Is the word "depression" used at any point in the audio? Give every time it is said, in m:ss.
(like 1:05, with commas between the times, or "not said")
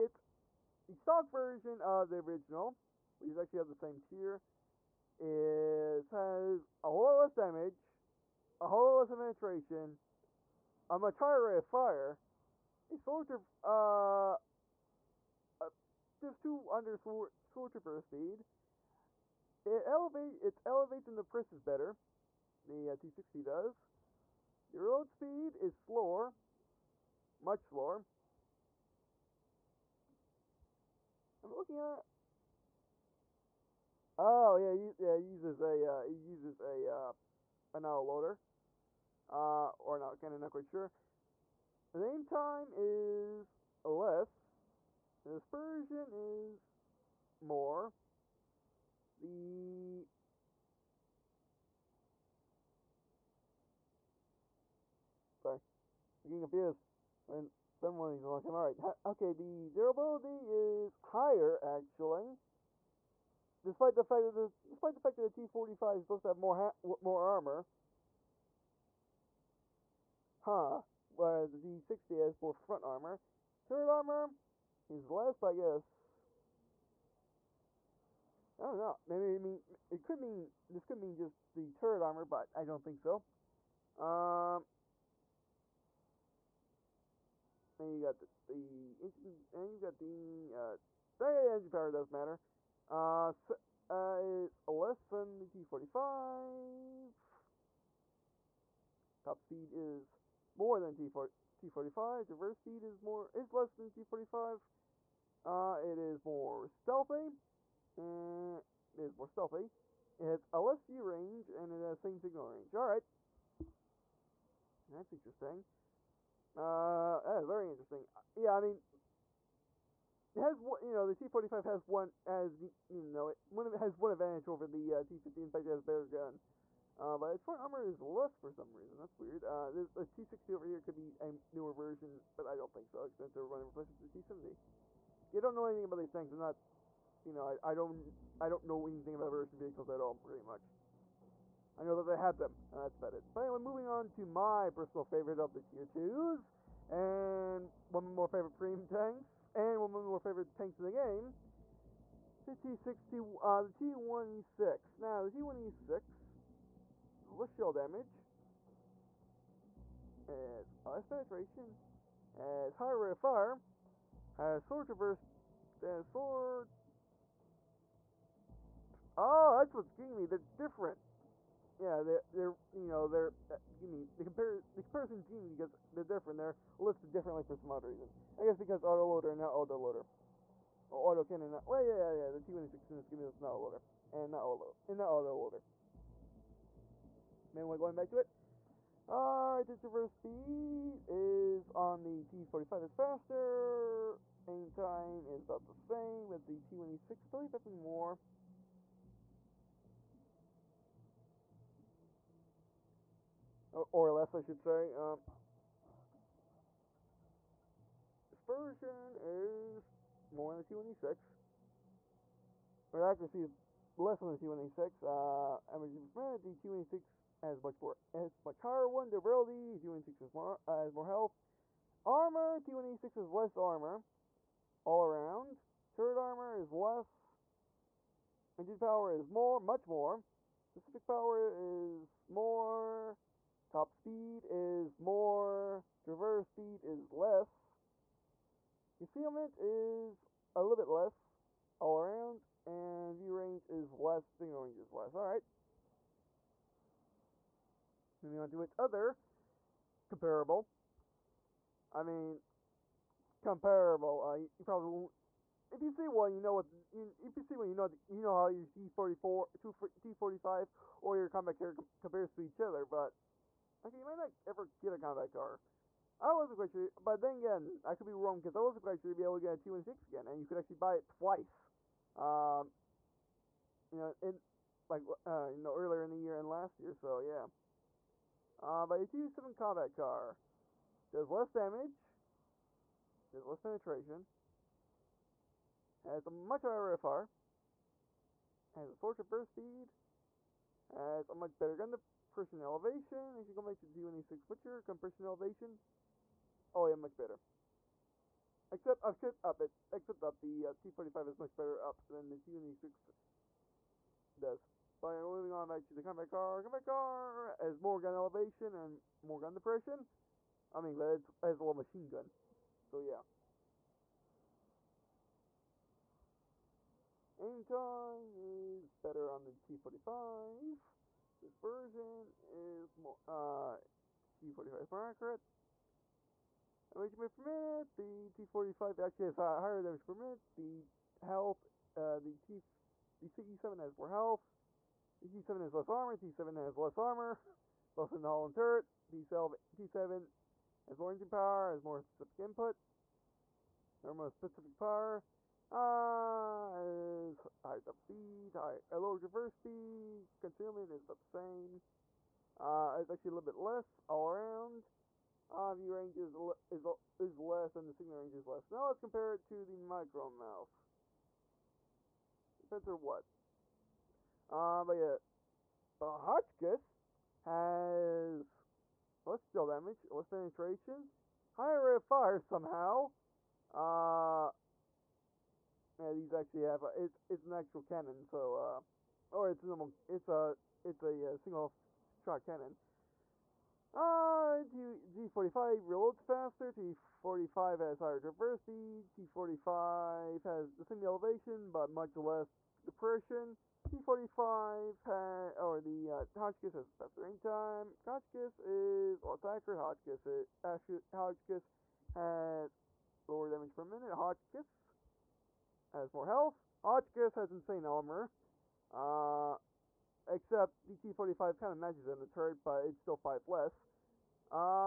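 5:09, 6:32.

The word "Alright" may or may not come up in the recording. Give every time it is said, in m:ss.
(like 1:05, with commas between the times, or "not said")
3:09, 4:05.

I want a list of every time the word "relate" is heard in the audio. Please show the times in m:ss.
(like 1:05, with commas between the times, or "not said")
not said.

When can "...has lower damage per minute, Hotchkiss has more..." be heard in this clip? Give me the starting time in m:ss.
6:42.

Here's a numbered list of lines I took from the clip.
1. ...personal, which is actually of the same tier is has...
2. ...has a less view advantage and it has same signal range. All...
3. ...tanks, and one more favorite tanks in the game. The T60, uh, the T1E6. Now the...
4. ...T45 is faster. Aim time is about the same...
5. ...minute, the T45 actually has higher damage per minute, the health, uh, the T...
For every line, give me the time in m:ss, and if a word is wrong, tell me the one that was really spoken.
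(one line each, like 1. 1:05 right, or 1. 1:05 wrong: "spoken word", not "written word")
1. 0:02 wrong: "original", not "personal"
2. 1:50 wrong: "range", not "advantage"
3. 2:28 right
4. 3:12 right
5. 5:27 right.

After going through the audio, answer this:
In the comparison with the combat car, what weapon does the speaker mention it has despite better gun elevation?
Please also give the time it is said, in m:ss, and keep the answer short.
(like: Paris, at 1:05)
A little machine gun, at 5:11.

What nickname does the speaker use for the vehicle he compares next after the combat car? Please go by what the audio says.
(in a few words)
Micro Mouse.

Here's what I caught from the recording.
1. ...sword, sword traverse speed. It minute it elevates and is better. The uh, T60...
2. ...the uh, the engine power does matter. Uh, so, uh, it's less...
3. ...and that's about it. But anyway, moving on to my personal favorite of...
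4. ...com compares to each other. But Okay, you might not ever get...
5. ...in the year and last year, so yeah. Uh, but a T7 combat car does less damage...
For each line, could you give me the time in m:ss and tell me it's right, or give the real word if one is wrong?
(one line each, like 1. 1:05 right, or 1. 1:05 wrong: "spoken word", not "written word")
1. 0:16 wrong: "elevate", not "minute"
2. 1:29 right
3. 2:22 right
4. 4:21 right
5. 4:36 right.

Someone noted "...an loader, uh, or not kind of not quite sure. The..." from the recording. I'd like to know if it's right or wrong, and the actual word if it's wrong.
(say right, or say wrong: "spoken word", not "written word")
right.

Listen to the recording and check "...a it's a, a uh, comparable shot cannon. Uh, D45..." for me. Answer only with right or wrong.
wrong.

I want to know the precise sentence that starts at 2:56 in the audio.
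They're listed differently for some odd reason.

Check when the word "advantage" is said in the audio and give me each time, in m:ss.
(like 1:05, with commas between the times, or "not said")
2:04.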